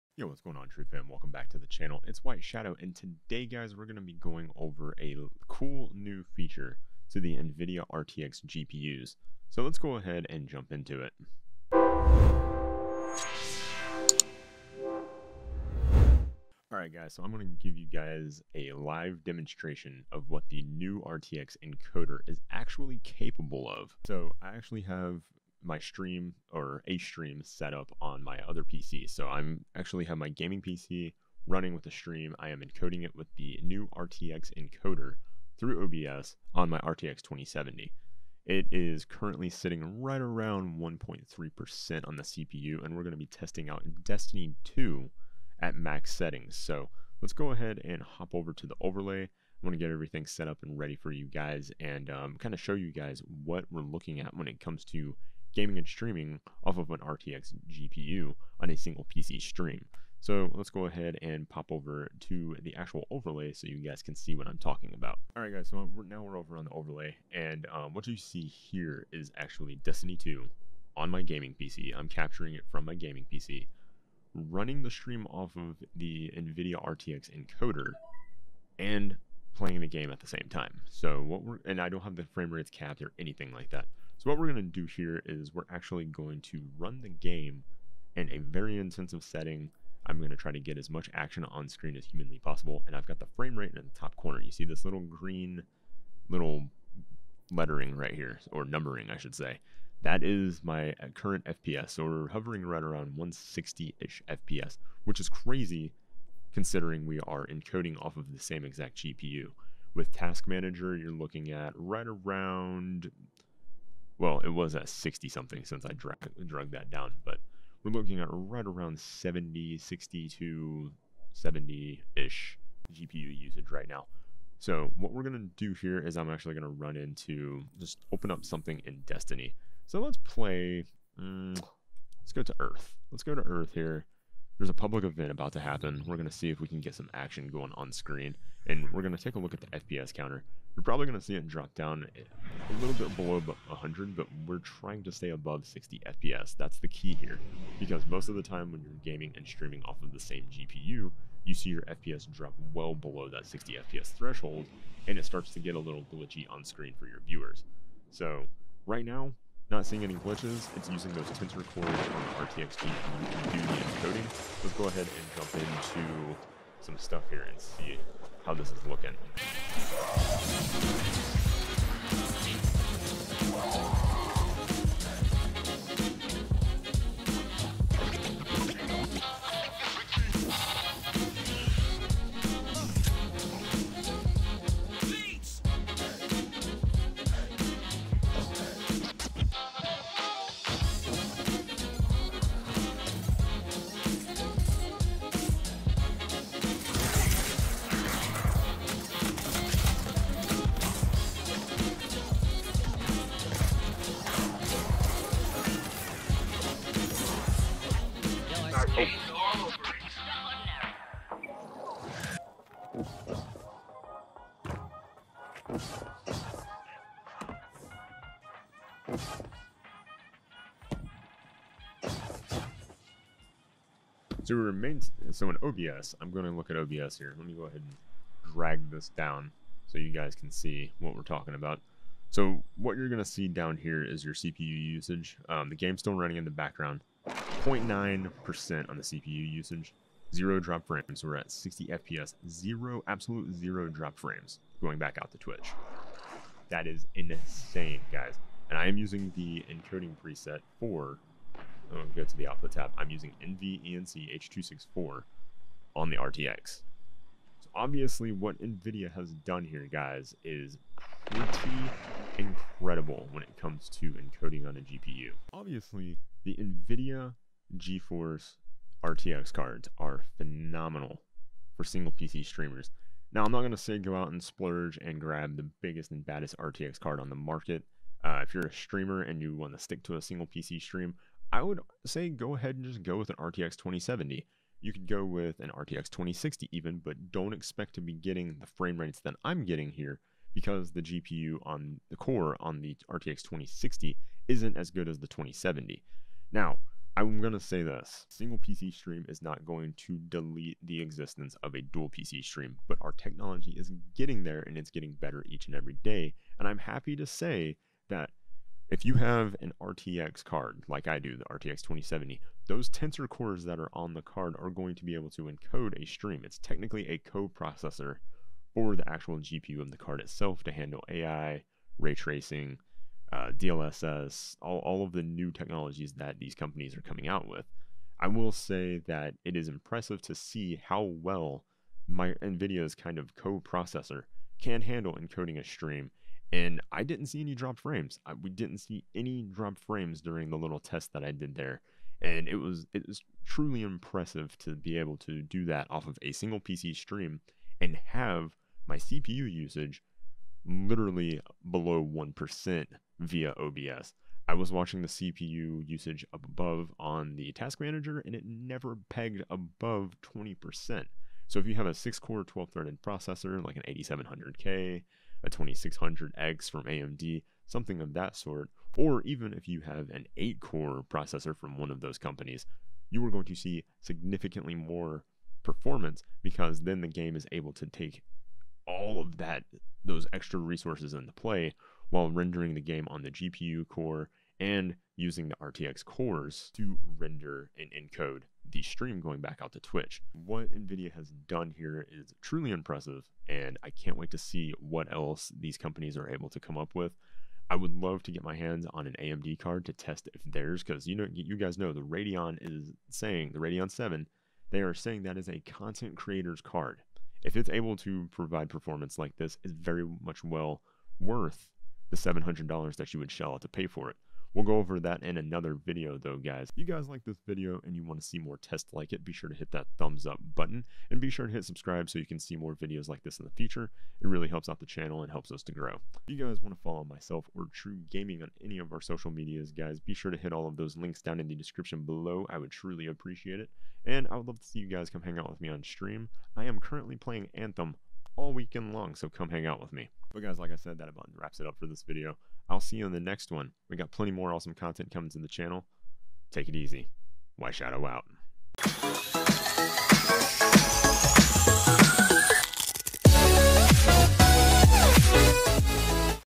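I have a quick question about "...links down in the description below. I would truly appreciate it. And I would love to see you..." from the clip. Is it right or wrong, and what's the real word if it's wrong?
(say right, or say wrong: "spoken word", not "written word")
right.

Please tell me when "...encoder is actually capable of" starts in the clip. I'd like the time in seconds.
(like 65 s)
21 s.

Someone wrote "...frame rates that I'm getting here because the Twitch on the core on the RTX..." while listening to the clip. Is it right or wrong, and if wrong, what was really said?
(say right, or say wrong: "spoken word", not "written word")
wrong: "GPU", not "Twitch".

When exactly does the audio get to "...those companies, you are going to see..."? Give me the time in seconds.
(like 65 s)
372 s.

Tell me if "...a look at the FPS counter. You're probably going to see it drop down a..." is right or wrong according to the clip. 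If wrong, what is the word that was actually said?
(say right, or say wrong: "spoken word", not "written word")
right.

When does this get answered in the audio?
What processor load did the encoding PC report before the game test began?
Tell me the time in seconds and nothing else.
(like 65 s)
40 s.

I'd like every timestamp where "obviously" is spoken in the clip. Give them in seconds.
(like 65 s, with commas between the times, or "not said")
257 s, 265 s.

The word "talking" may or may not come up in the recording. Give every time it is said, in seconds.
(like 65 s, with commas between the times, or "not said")
64 s, 231 s.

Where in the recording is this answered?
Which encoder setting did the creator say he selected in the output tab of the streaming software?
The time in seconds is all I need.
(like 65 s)
253 s.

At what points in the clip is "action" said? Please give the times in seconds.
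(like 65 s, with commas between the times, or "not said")
91 s, 137 s.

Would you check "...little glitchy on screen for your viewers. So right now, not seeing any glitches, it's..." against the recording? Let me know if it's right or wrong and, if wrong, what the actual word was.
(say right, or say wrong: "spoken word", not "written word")
right.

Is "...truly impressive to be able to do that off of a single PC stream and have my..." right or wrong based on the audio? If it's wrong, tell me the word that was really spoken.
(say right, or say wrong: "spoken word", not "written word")
right.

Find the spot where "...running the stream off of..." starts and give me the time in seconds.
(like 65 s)
74 s.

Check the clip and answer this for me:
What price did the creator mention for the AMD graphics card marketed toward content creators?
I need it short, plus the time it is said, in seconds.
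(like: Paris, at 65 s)
$700, at 412 s.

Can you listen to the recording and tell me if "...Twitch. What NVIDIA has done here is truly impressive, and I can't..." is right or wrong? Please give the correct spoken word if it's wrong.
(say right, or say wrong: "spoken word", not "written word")
right.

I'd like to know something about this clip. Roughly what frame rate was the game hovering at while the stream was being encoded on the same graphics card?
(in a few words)
160.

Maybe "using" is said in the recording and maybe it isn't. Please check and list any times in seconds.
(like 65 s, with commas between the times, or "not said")
160 s, 248 s, 253 s, 385 s.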